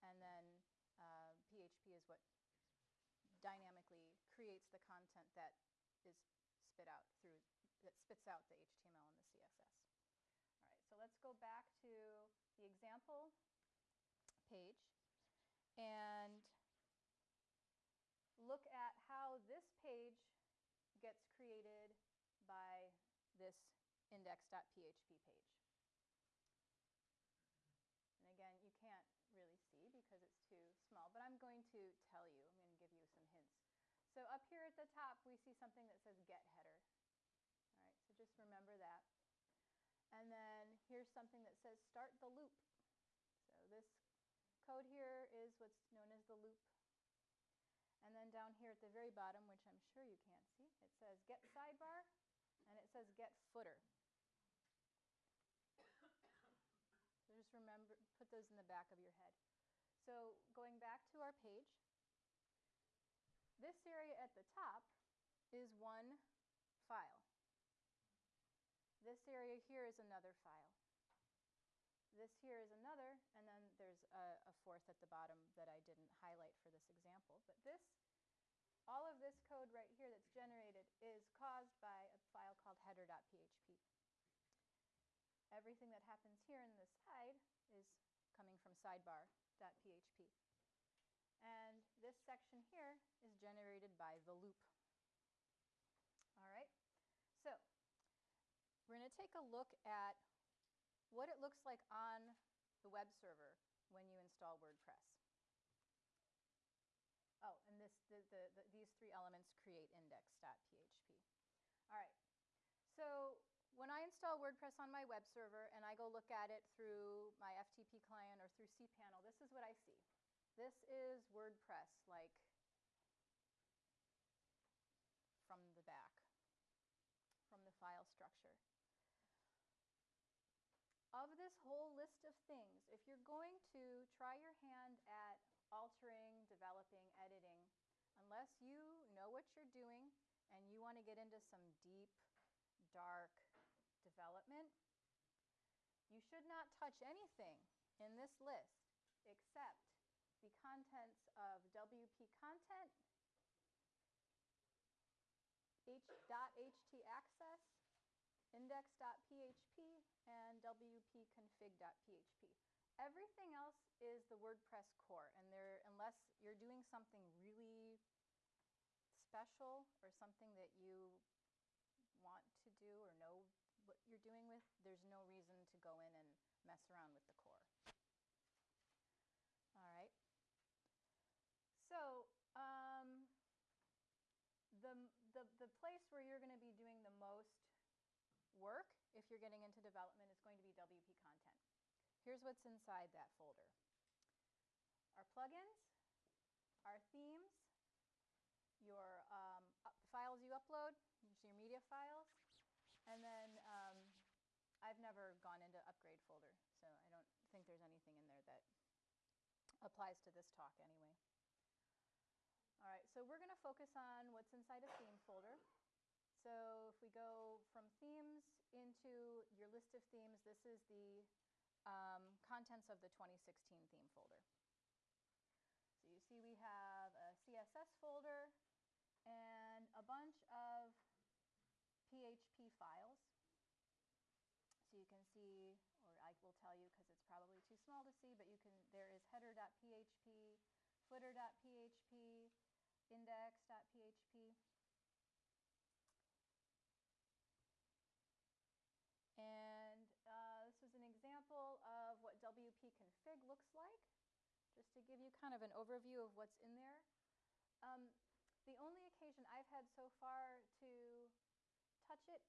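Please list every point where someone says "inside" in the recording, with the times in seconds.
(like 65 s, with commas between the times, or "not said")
192 s, 214 s.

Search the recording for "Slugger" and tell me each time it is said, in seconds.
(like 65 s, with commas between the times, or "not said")
not said.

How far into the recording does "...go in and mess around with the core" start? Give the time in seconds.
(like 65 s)
175 s.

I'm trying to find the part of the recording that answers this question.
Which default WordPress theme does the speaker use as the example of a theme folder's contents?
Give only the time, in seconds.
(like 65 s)
223 s.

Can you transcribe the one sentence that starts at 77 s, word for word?
But this, all of this code right here that's generated is caused by a file called header.php.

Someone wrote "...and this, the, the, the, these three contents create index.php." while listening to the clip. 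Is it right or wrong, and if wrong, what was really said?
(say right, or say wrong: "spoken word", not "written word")
wrong: "elements", not "contents".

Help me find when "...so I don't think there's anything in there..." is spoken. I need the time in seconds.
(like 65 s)
206 s.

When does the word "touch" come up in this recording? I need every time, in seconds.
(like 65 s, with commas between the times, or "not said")
146 s.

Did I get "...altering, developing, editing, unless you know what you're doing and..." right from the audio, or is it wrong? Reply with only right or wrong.
right.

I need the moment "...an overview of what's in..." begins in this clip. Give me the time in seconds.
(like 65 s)
255 s.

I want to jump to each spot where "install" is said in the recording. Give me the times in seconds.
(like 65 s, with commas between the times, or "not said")
104 s, 114 s.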